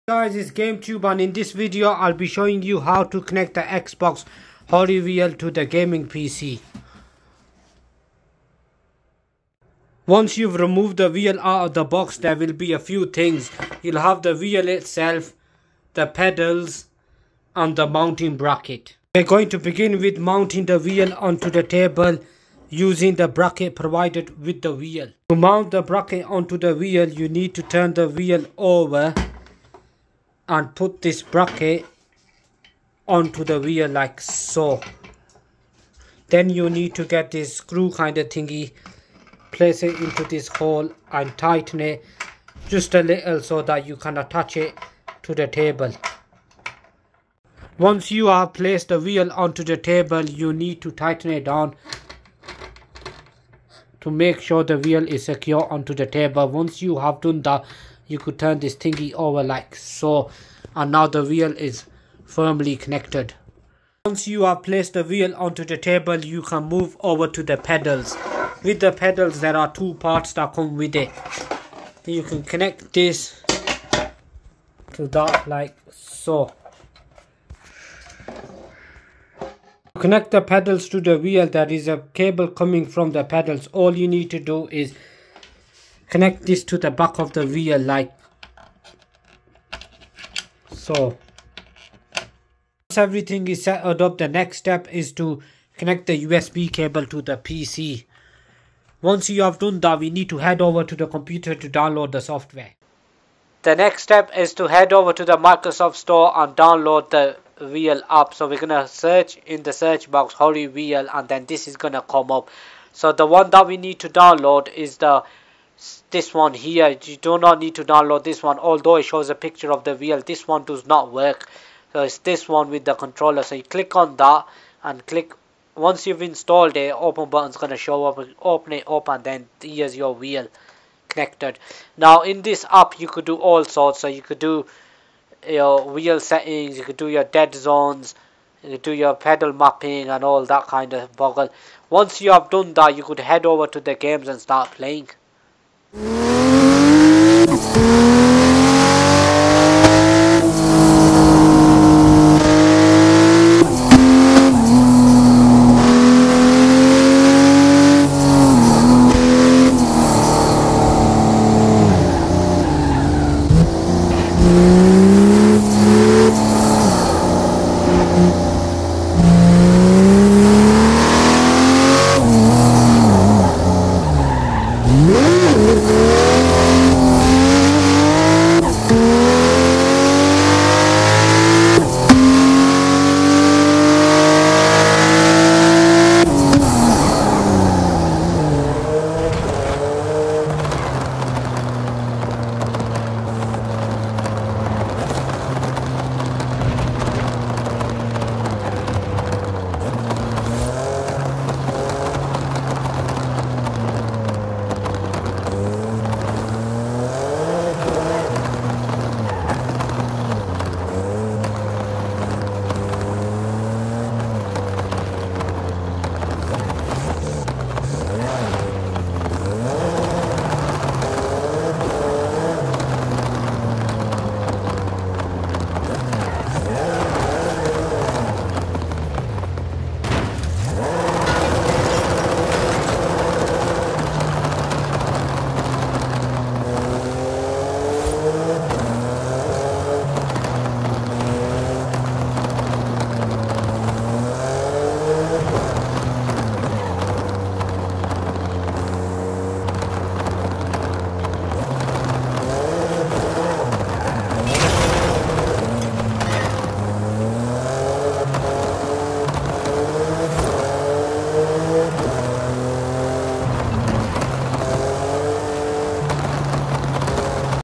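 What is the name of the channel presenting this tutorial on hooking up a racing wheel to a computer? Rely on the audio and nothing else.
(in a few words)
GameTube.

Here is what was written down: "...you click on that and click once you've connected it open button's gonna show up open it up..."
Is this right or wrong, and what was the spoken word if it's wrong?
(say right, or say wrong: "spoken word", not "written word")
wrong: "installed", not "connected".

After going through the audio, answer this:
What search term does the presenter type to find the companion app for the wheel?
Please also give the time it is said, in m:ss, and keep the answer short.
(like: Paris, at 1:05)
HORI Real, at 1:50.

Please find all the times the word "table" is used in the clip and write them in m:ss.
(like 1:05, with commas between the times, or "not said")
0:21, 0:45, 0:49, 0:56, 1:05.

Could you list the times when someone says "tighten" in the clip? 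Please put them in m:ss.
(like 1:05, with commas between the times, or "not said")
0:41, 0:50.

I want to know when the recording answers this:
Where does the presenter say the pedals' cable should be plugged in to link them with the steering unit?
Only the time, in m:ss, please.
1:26.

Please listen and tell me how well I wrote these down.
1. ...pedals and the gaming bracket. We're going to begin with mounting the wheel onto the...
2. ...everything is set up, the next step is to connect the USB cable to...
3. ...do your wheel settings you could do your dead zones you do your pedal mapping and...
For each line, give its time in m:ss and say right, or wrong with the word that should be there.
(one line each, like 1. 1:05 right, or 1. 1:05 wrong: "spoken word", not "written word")
1. 0:16 wrong: "mounting", not "gaming"
2. 1:32 right
3. 2:14 right.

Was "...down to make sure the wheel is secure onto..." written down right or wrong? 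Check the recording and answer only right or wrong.
right.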